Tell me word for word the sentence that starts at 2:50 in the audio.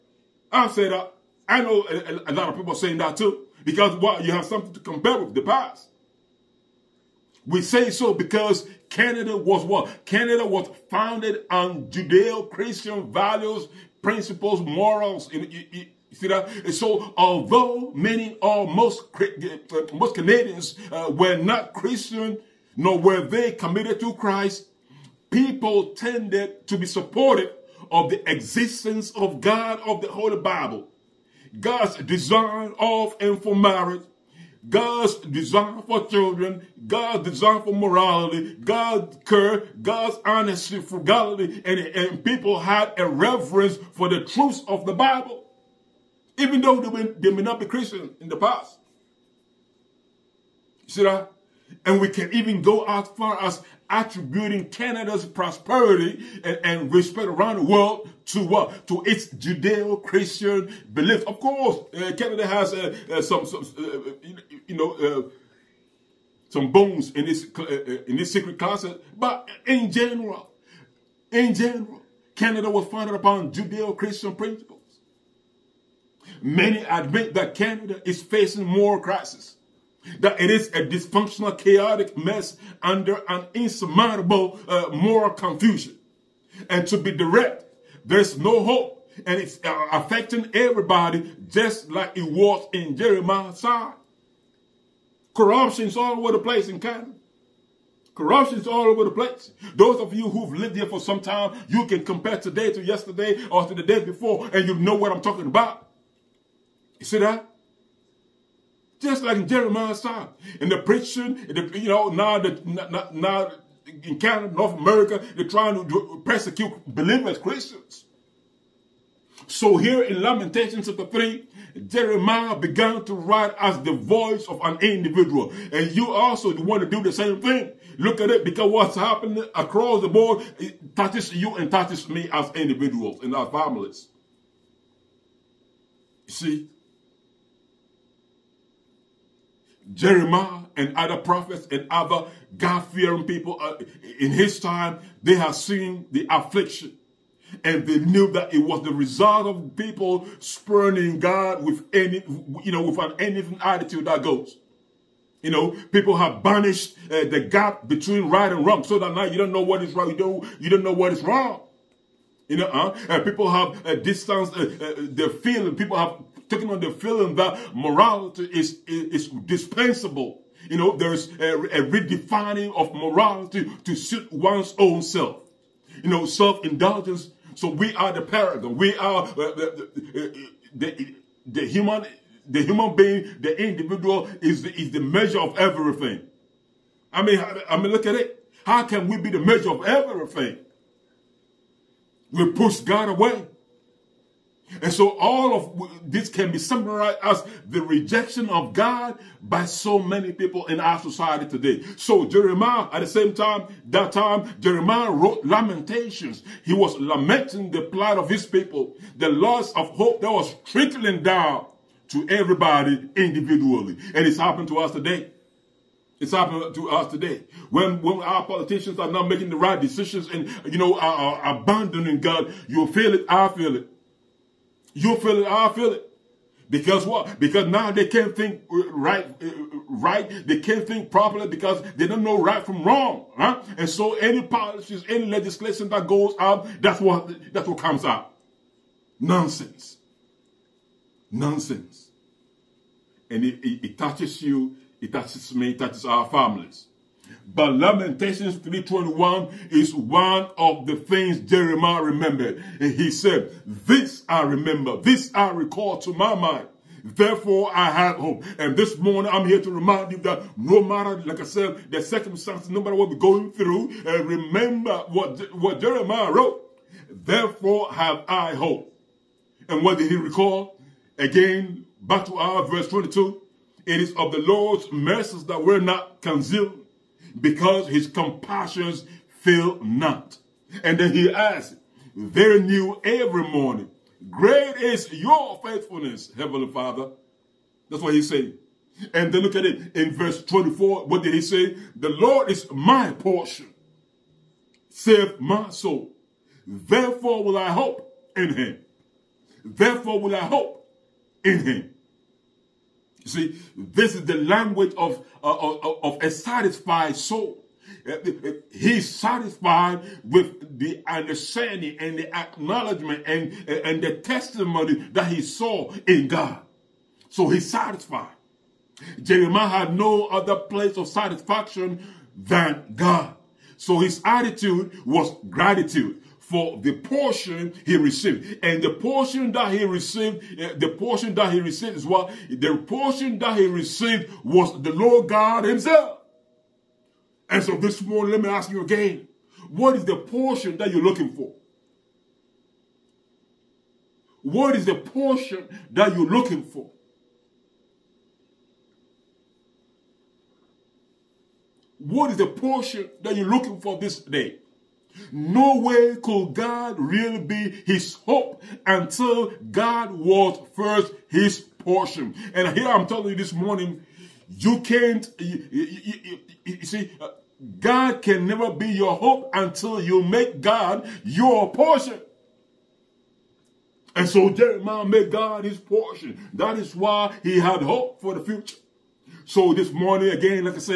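You know, there's a, a redefining of morality to suit one's own self.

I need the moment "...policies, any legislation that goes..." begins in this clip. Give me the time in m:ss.
3:54.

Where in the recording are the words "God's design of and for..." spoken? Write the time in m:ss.
0:31.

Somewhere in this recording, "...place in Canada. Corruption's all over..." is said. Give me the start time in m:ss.
1:36.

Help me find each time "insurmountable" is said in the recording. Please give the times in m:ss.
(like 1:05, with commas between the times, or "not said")
1:23.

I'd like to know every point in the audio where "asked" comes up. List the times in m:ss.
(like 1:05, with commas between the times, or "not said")
not said.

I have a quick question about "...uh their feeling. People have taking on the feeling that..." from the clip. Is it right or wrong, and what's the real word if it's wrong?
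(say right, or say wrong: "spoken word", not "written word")
right.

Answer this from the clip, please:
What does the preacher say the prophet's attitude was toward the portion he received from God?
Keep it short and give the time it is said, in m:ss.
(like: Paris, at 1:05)
gratitude, at 5:25.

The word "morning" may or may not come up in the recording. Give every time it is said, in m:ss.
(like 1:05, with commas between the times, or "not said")
4:18, 4:43, 5:38, 6:03, 6:19.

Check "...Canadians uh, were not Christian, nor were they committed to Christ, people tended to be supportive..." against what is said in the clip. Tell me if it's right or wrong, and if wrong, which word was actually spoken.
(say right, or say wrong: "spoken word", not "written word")
right.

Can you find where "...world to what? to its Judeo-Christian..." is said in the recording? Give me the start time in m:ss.
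0:57.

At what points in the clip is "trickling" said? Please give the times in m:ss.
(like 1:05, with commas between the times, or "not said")
3:30.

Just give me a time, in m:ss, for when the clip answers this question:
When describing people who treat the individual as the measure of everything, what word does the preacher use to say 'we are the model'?
2:58.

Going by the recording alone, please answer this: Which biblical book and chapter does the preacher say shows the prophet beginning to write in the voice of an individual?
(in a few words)
Lamentations chapter 3.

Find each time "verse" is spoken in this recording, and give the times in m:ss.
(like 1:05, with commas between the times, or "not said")
4:32, 4:50.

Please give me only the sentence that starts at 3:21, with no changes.
So Jeremiah, at the same time, that time, Jeremiah wrote Lamentations.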